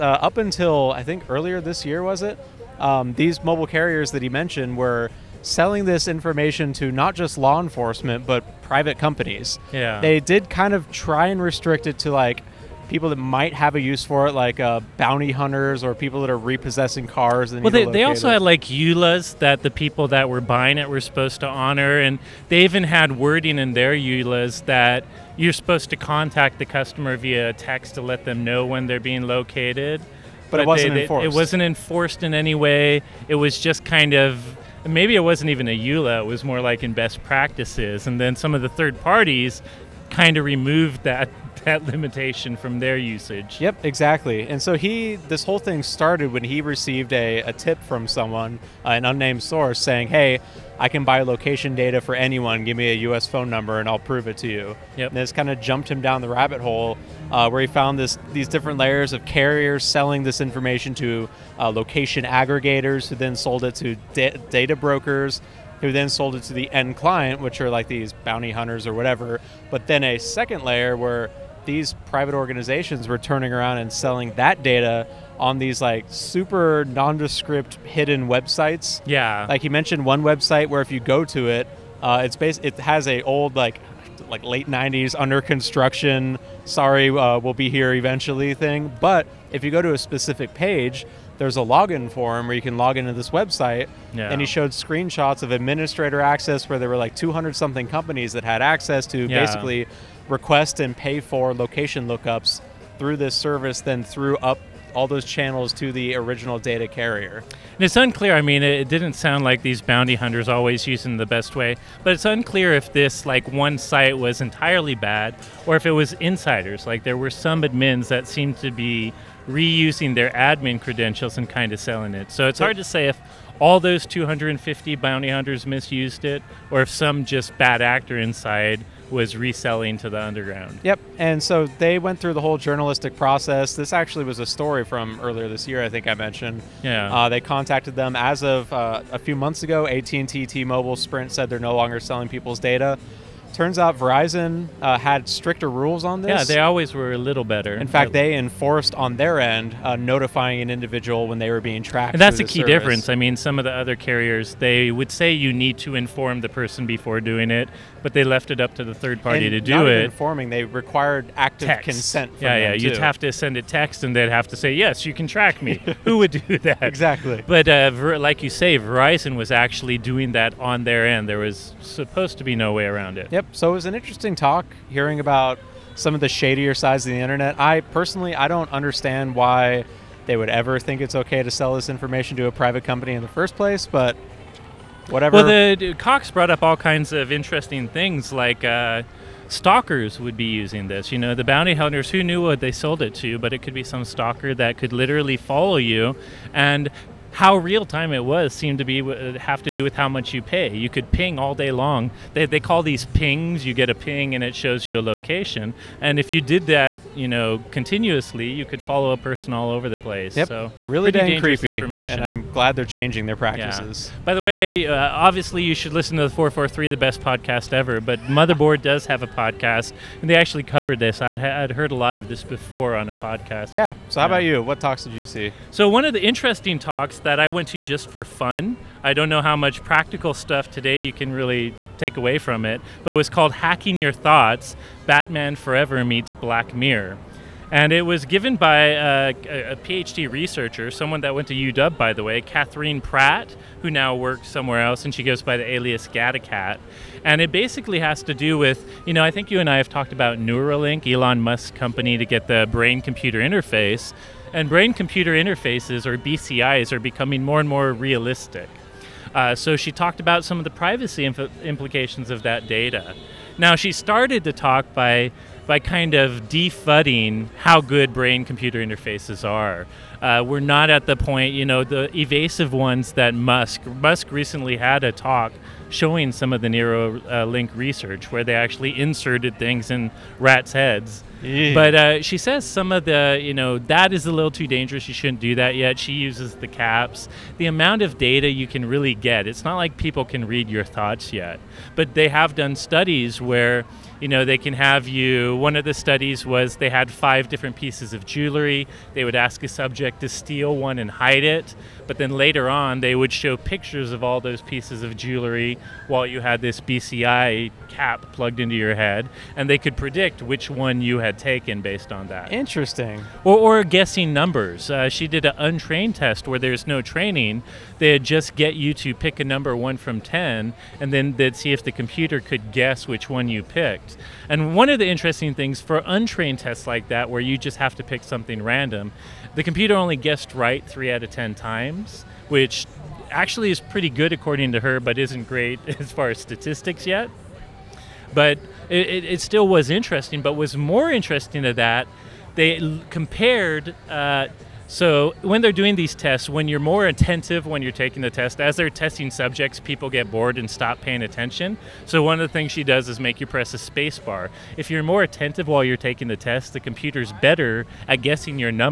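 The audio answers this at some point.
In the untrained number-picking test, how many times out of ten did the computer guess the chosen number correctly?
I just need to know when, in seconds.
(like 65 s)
330 s.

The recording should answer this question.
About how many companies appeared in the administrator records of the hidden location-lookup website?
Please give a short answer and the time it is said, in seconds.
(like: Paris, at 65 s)
200 something, at 97 s.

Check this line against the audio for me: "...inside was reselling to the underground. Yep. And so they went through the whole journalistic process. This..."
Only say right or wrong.
right.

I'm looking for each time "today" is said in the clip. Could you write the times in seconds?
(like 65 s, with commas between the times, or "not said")
230 s.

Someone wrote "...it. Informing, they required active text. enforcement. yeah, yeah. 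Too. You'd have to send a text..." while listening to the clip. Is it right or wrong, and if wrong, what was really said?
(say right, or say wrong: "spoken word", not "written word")
wrong: "consent", not "enforcement".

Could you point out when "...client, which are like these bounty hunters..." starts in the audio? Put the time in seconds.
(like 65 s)
66 s.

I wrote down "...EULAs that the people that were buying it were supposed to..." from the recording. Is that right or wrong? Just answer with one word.
right.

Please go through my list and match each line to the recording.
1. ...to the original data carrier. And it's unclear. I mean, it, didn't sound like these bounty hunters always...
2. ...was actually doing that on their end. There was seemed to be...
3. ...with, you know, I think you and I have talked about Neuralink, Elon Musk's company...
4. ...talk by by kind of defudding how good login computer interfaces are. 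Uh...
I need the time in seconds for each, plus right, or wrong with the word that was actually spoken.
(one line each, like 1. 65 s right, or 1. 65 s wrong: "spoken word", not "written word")
1. 105 s right
2. 169 s wrong: "supposed", not "seemed"
3. 248 s right
4. 264 s wrong: "brain", not "login".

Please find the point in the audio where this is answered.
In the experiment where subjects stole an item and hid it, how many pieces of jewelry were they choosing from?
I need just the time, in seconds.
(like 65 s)
297 s.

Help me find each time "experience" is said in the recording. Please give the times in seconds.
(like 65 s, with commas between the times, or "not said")
not said.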